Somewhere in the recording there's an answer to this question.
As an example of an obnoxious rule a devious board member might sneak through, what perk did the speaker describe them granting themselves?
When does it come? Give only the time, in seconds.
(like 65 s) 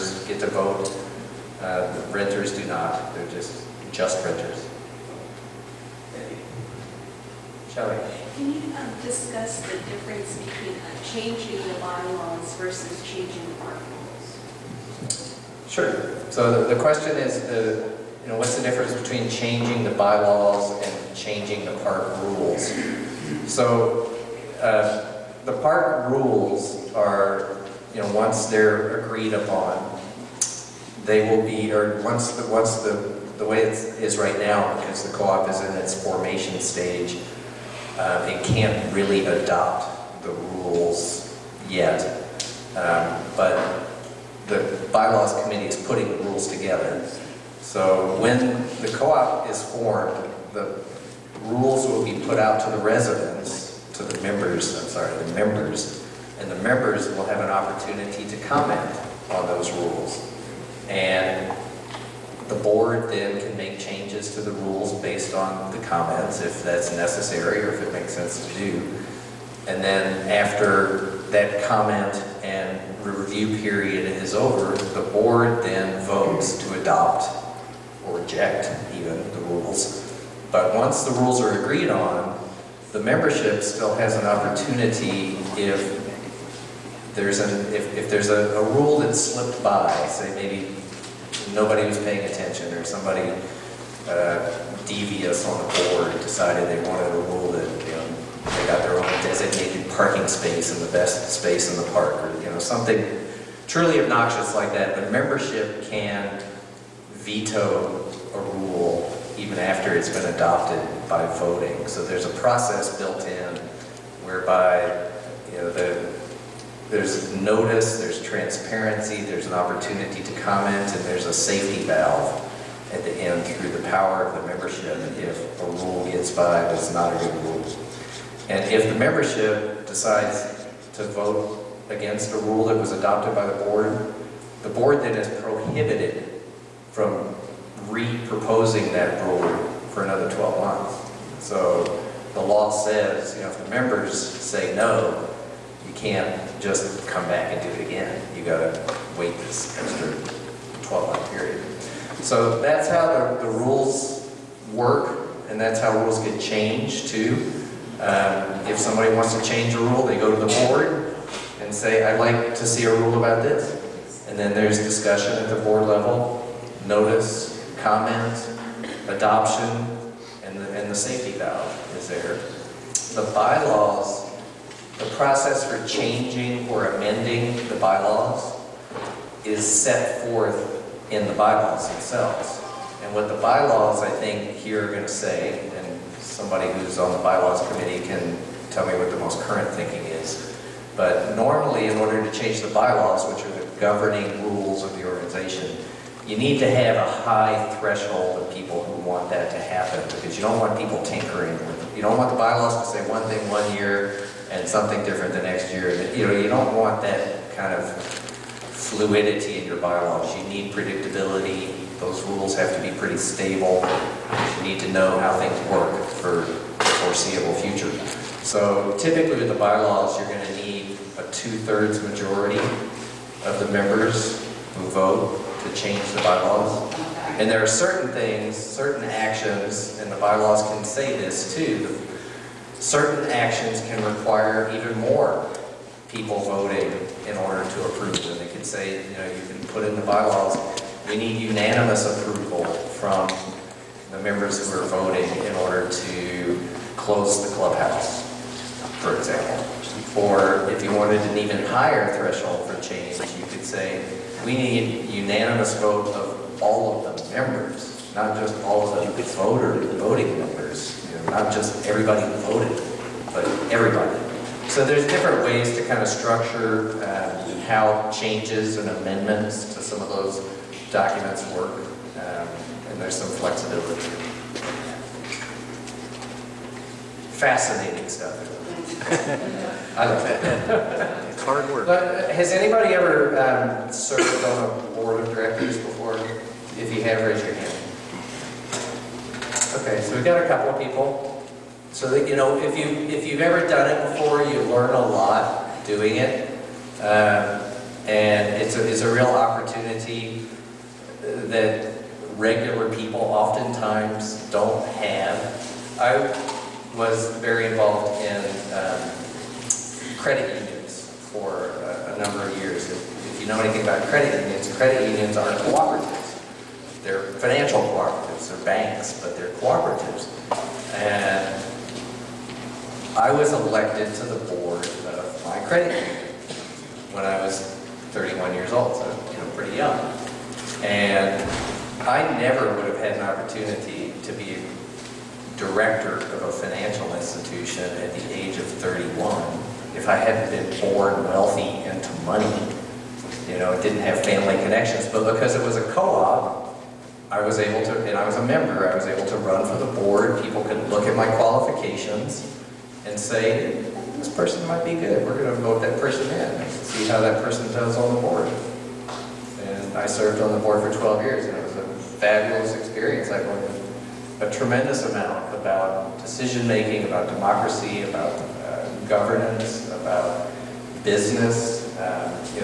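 99 s.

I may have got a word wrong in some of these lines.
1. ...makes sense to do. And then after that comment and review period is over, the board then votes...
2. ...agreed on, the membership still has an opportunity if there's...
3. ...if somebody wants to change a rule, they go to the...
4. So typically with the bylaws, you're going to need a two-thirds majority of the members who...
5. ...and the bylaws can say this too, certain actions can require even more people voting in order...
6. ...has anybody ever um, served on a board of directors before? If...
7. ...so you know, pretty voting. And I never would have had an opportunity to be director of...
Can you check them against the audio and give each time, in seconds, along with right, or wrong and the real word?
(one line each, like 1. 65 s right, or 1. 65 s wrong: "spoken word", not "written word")
1. 67 s right
2. 81 s right
3. 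158 s right
4. 218 s right
5. 229 s right
6. 282 s right
7. 328 s wrong: "young", not "voting".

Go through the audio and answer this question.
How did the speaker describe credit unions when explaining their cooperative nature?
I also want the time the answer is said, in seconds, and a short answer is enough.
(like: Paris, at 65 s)
financial cooperatives, at 317 s.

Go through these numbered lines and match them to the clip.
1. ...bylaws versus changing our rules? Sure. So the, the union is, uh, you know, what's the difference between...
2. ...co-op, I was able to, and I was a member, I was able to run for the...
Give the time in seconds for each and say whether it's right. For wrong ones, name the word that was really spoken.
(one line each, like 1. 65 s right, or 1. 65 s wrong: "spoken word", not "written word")
1. 11 s wrong: "question", not "union"
2. 345 s right.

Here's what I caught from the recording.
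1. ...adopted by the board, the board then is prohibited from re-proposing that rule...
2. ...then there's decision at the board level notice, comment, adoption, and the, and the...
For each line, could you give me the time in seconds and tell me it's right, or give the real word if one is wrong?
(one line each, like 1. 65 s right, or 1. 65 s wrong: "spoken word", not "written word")
1. 132 s right
2. 164 s wrong: "discussion", not "decision".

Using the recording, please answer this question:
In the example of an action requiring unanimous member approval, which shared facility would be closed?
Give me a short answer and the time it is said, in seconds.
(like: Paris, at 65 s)
the clubhouse, at 247 s.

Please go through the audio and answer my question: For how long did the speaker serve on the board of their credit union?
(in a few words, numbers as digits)
12 years.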